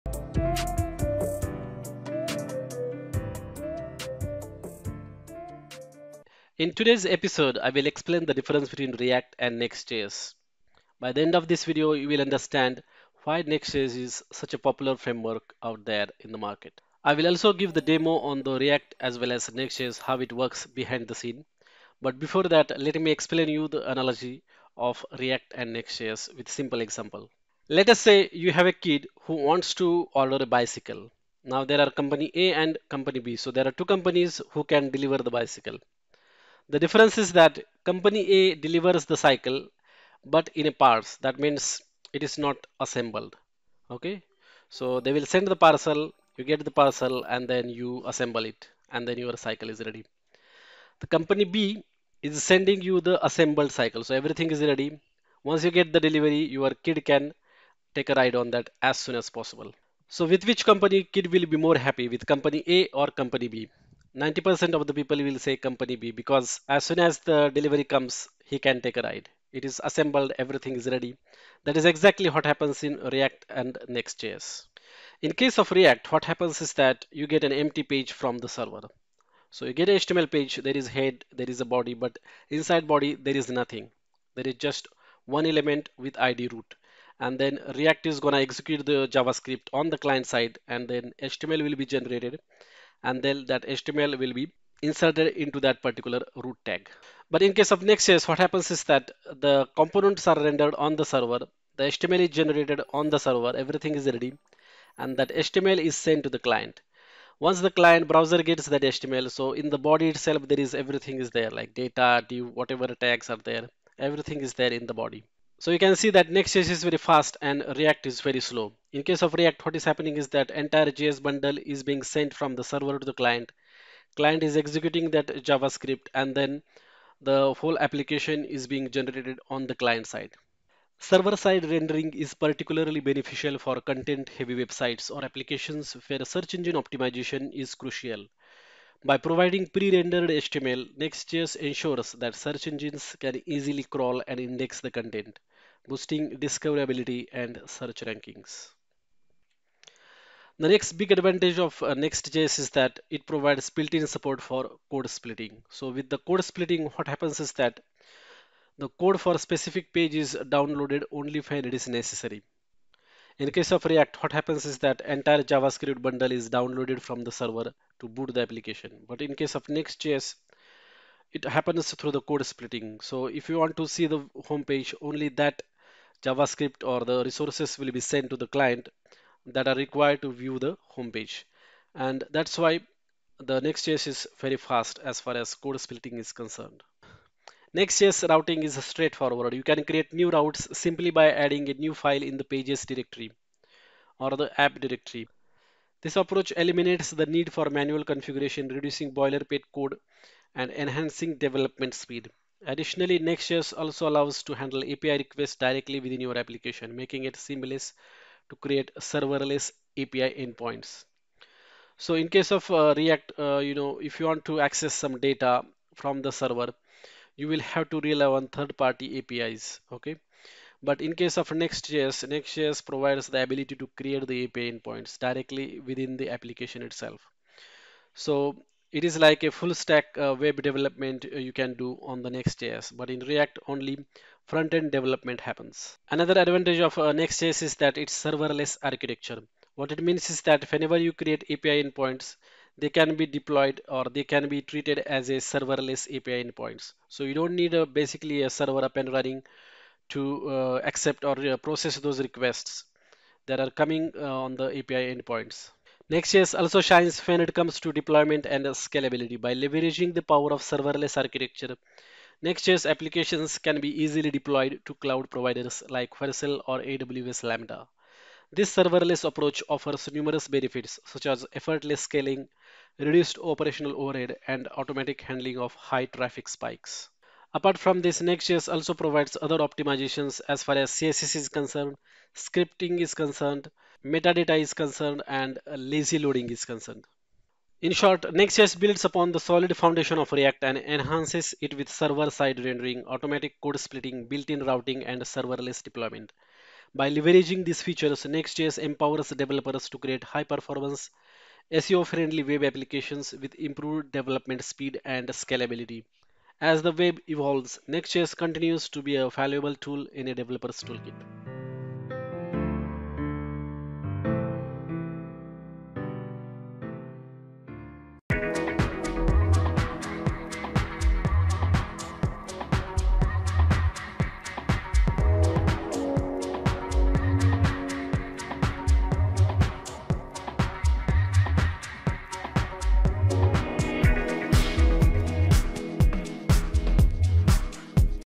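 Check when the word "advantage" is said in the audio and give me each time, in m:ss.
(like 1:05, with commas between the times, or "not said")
2:31, 3:56.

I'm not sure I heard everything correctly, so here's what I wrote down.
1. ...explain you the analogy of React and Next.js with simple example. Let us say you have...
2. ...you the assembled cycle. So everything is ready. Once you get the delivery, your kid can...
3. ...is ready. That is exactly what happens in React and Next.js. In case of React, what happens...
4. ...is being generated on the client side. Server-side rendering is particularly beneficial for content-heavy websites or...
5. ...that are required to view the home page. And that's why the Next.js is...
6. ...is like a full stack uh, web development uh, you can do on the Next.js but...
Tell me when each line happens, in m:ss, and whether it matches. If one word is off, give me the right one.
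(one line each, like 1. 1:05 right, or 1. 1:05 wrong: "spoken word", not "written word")
1. 0:23 right
2. 0:52 right
3. 1:10 right
4. 2:08 right
5. 2:59 right
6. 3:49 right.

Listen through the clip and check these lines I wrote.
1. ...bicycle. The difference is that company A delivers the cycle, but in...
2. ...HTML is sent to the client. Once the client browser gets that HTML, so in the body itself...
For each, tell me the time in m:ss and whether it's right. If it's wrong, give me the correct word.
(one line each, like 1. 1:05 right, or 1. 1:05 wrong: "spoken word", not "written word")
1. 0:35 right
2. 1:45 right.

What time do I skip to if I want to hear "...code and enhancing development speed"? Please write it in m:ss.
3:19.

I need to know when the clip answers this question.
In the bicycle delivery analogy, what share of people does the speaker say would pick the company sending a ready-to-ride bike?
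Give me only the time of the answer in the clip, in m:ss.
1:04.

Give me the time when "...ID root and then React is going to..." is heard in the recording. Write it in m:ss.
1:26.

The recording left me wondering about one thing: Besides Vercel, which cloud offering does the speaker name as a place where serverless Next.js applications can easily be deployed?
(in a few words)
AWS Lambda.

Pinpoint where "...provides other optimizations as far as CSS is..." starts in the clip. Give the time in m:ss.
4:38.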